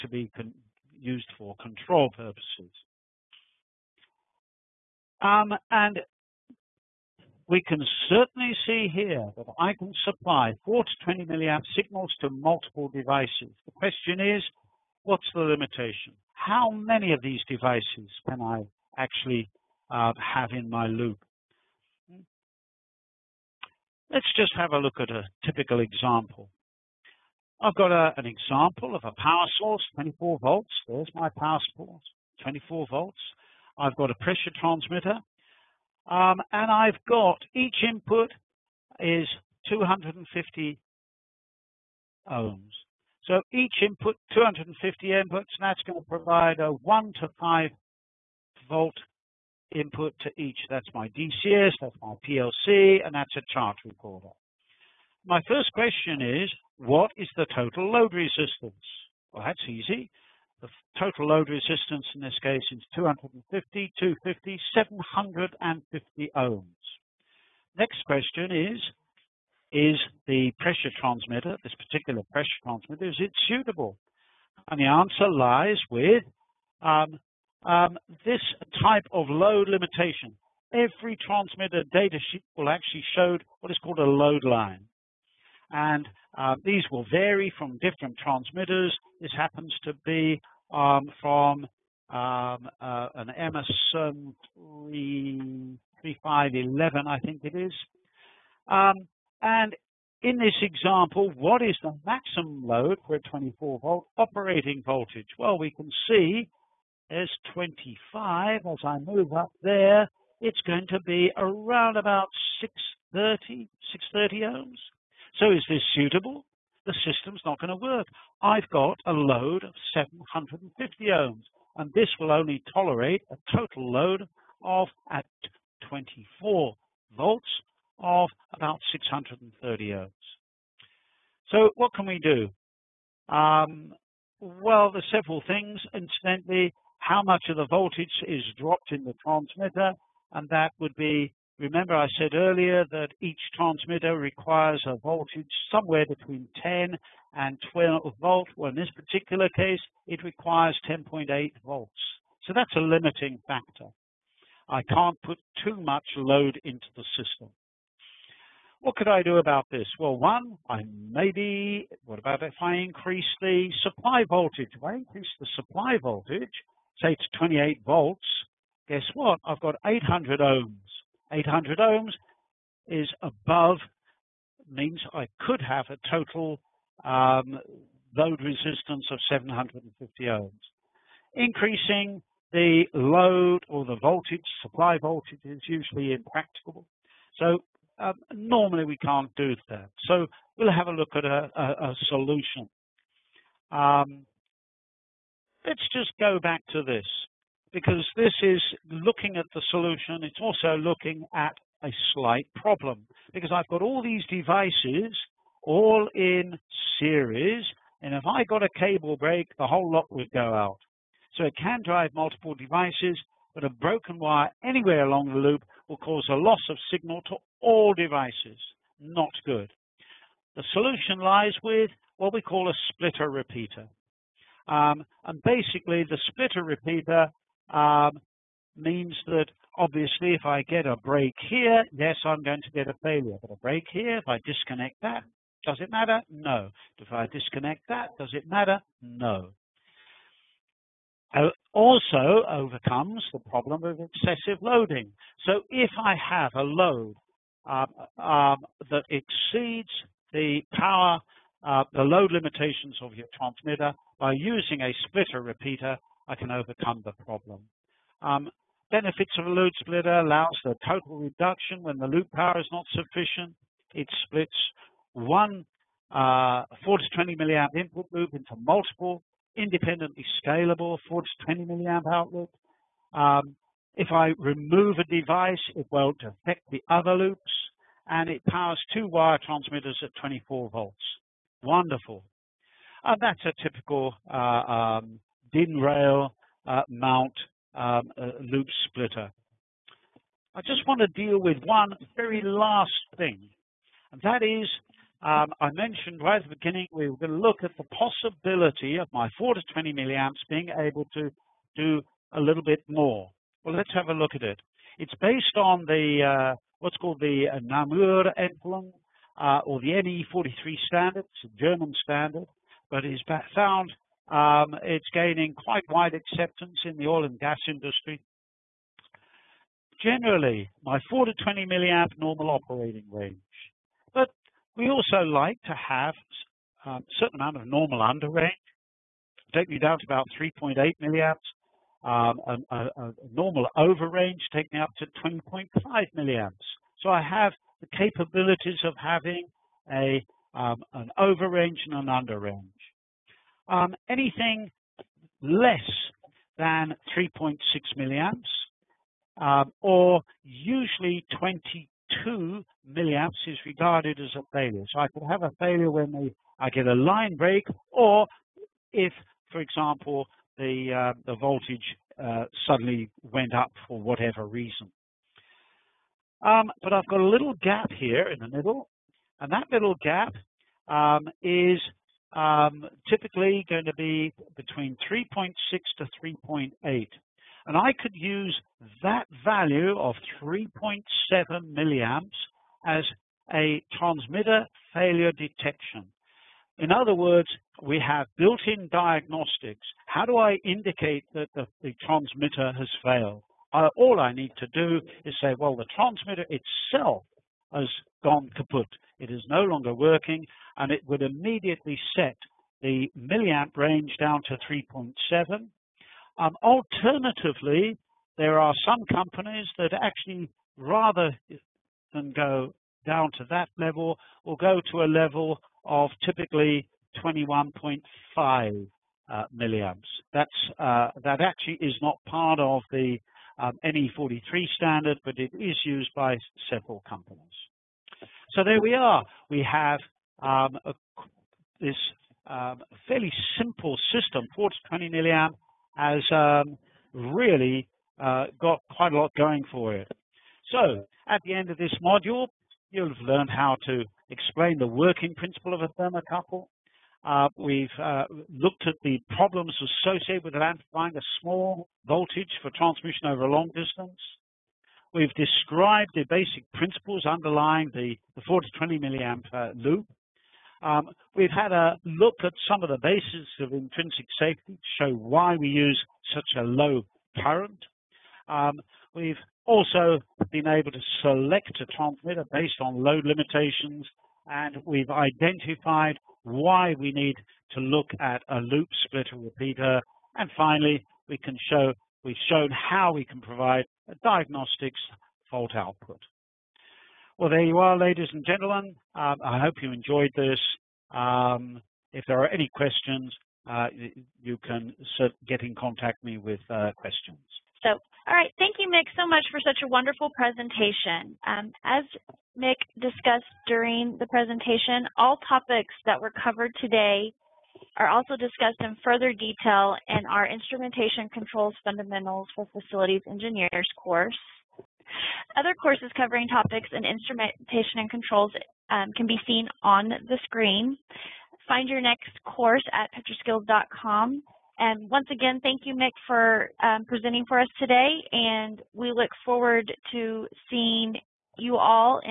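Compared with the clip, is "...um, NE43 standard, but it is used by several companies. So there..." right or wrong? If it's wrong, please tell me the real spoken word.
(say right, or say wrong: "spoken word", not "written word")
right.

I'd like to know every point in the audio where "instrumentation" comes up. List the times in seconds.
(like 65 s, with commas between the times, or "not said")
510 s, 517 s.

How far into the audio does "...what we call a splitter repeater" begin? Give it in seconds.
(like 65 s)
222 s.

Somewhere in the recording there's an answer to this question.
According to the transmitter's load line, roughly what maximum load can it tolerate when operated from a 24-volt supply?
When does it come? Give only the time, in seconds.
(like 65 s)
112 s.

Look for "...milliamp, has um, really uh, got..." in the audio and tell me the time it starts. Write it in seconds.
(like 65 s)
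435 s.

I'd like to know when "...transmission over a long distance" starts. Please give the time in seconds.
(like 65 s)
452 s.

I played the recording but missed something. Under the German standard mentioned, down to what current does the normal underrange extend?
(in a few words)
3.8 milliamps.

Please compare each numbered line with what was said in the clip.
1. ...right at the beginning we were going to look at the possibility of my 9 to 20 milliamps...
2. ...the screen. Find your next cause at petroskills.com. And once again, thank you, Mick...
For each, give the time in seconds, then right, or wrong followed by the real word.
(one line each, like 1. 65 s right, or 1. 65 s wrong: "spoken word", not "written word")
1. 296 s wrong: "4", not "9"
2. 520 s wrong: "course", not "cause".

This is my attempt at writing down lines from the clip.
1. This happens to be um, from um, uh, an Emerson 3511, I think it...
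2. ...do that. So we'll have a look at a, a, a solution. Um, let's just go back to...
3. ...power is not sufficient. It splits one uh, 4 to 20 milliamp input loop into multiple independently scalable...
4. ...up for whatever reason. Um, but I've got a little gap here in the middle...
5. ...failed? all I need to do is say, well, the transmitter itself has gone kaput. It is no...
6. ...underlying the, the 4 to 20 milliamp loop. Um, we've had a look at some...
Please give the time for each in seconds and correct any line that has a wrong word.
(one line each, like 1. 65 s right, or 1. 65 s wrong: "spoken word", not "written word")
1. 89 s right
2. 189 s right
3. 262 s right
4. 363 s right
5. 393 s right
6. 457 s right.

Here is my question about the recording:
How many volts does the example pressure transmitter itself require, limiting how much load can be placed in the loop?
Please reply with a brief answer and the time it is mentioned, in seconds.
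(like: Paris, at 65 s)
10.8 volts, at 150 s.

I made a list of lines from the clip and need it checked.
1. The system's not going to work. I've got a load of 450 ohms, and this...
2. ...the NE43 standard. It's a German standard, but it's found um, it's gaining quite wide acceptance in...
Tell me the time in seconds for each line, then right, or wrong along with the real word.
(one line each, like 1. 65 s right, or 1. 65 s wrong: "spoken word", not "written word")
1. 116 s wrong: "750", not "450"
2. 309 s right.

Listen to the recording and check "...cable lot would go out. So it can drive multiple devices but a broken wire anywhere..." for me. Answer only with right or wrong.
wrong.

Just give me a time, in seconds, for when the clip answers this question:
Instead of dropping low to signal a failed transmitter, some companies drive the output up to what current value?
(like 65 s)
417 s.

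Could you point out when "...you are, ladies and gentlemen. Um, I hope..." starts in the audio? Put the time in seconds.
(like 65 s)
487 s.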